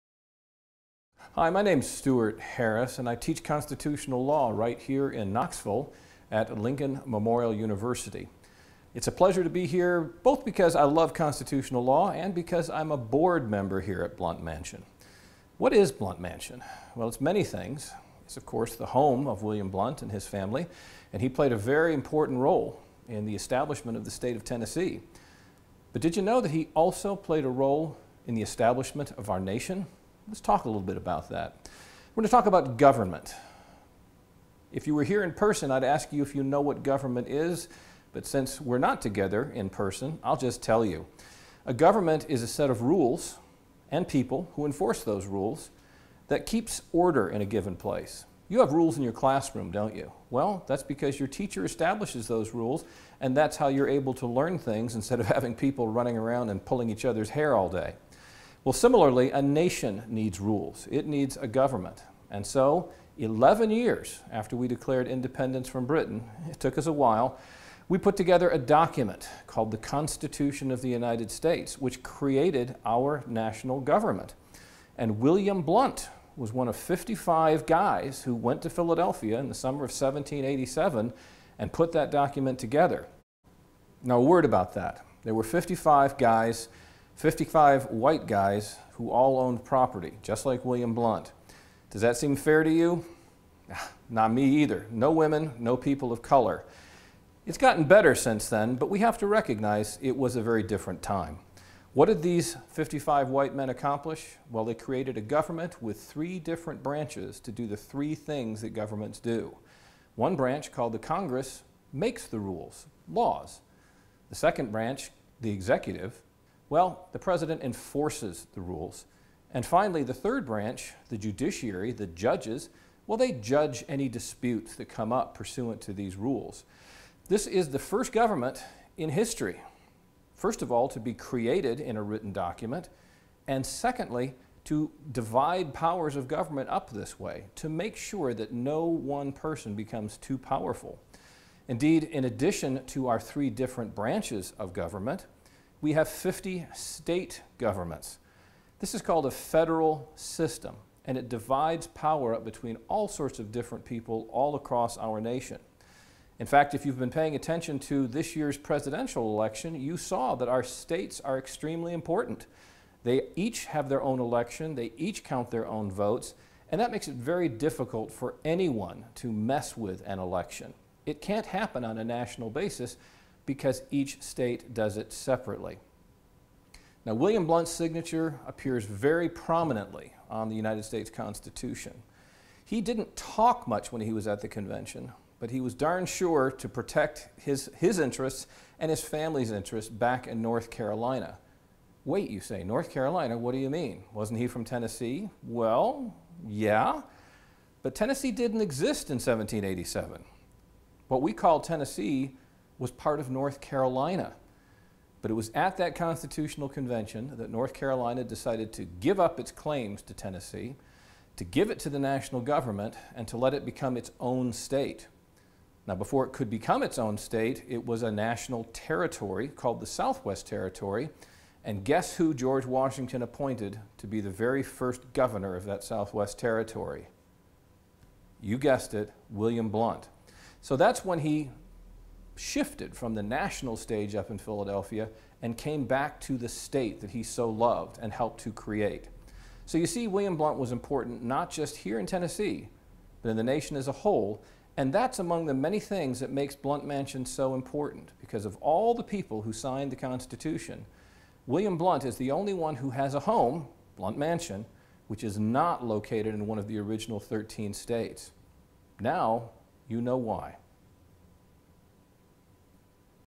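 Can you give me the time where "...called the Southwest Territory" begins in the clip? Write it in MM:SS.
03:39.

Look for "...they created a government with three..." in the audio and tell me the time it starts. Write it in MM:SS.
01:44.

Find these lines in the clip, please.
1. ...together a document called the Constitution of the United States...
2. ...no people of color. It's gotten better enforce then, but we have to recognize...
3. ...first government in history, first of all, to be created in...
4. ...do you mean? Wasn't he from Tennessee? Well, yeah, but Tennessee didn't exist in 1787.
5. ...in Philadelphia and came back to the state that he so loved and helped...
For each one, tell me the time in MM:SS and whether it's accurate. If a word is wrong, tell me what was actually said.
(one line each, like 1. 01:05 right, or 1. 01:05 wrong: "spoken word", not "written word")
1. 01:08 right
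2. 01:35 wrong: "since", not "enforce"
3. 02:07 right
4. 03:13 right
5. 03:54 right.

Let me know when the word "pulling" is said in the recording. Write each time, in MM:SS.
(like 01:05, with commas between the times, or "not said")
00:56.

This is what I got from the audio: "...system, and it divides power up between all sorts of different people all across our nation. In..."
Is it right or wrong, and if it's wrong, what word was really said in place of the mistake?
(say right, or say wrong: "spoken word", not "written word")
right.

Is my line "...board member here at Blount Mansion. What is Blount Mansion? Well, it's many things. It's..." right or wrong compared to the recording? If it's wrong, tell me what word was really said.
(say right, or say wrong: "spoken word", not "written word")
right.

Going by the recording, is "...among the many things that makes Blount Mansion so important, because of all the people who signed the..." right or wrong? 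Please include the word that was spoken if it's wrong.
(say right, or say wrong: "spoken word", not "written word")
right.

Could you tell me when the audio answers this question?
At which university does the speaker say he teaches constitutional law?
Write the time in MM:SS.
00:06.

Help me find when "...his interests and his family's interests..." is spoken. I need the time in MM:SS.
03:07.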